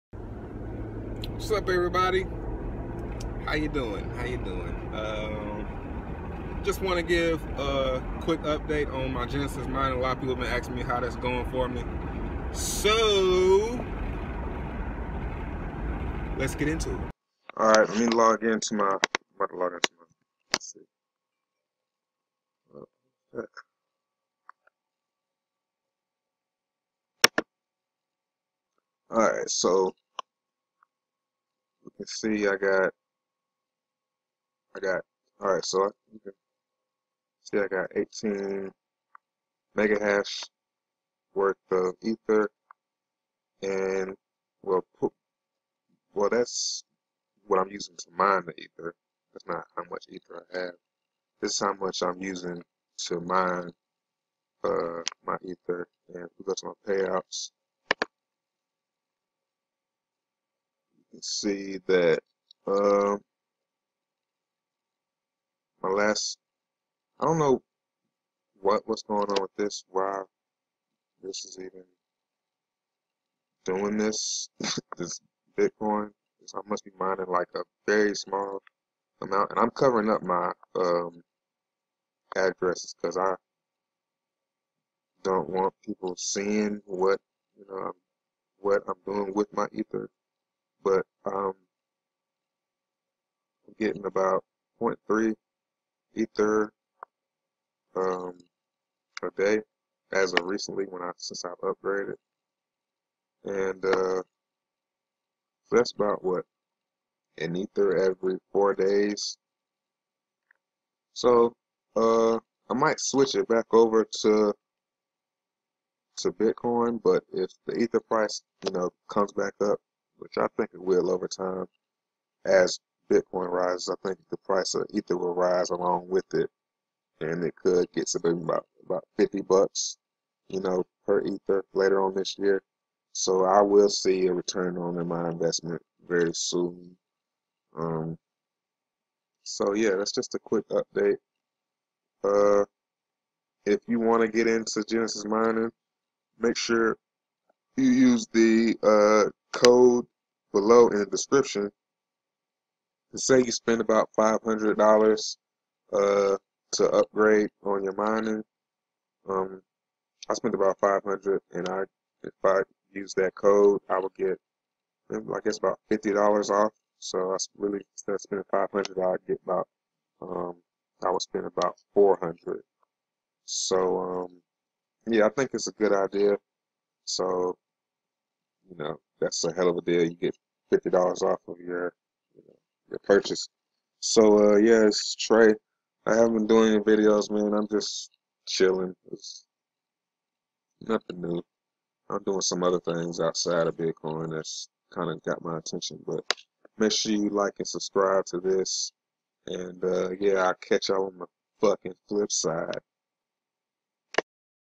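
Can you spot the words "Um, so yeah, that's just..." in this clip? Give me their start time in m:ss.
2:17.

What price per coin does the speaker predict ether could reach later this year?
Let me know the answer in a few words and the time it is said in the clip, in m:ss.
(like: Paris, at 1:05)
$50, at 2:09.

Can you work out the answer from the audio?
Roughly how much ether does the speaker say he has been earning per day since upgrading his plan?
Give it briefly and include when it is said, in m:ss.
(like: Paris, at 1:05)
0.3 ether, at 1:34.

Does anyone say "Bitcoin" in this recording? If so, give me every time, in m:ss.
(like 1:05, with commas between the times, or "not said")
1:15, 1:56, 2:03, 3:13.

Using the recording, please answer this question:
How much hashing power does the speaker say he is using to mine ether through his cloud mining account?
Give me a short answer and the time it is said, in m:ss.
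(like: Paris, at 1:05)
18 megahash, at 0:37.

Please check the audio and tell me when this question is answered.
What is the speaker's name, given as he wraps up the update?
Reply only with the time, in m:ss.
3:05.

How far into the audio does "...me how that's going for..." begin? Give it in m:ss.
0:10.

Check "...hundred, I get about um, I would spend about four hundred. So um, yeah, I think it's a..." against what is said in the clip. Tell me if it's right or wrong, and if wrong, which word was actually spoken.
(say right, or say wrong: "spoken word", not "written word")
right.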